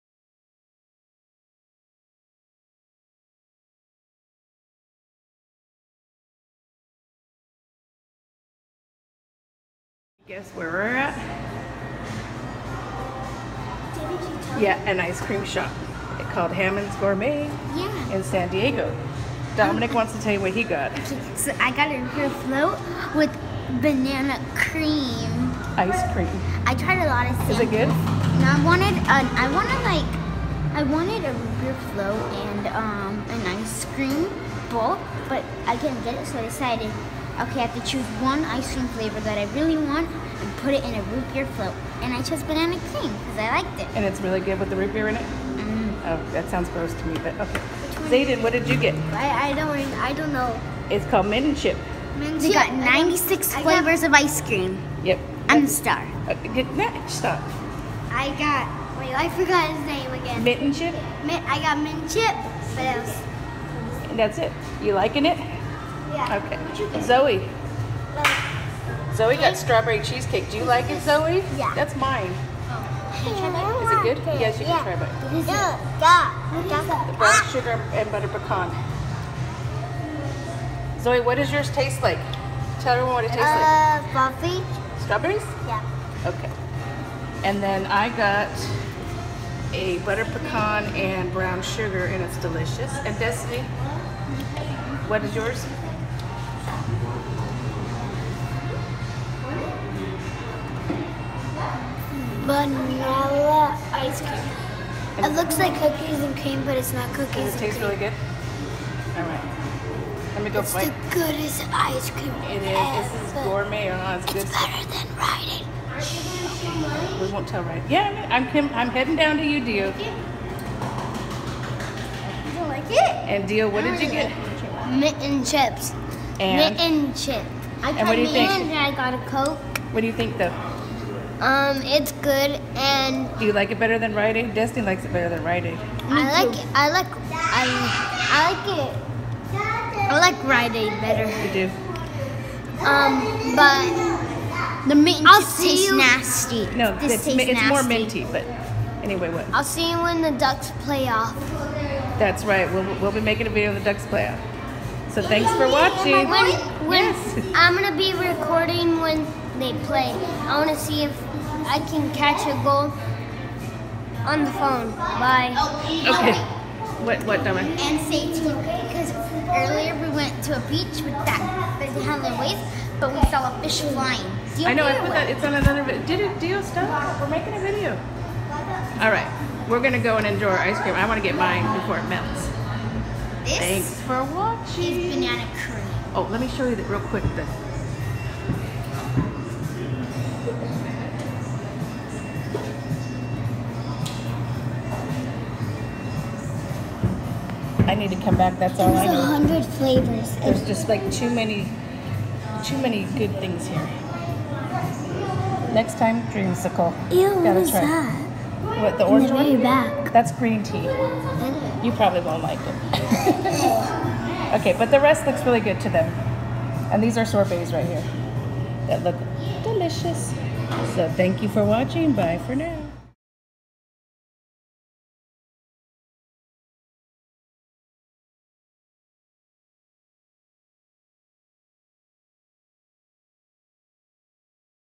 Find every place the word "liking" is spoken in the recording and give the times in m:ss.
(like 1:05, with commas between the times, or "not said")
1:04.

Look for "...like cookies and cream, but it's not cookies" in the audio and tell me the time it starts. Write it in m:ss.
1:45.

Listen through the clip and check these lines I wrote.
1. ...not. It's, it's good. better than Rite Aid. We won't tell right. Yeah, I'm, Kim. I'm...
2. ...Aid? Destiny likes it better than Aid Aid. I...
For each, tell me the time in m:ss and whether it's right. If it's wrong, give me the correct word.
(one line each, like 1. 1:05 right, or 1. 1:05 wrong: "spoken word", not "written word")
1. 1:53 right
2. 2:14 wrong: "Rite", not "Aid".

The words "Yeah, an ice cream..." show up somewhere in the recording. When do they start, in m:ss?
0:14.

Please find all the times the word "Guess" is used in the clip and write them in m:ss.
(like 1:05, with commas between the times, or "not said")
0:10.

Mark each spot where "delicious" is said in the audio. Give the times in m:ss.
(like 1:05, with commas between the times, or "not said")
1:32, 3:39.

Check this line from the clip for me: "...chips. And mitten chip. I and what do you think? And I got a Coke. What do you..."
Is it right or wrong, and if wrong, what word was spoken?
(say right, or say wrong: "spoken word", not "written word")
right.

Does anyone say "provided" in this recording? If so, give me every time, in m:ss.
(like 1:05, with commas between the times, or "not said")
not said.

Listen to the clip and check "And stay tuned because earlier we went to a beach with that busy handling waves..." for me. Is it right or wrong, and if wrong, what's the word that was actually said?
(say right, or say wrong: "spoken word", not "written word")
right.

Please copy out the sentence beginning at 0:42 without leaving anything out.
And I chose banana cream because I liked it.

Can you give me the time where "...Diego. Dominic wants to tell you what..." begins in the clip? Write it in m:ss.
0:18.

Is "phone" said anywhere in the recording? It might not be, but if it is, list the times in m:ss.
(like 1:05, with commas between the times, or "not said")
2:44.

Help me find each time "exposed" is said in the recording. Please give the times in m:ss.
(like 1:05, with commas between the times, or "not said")
not said.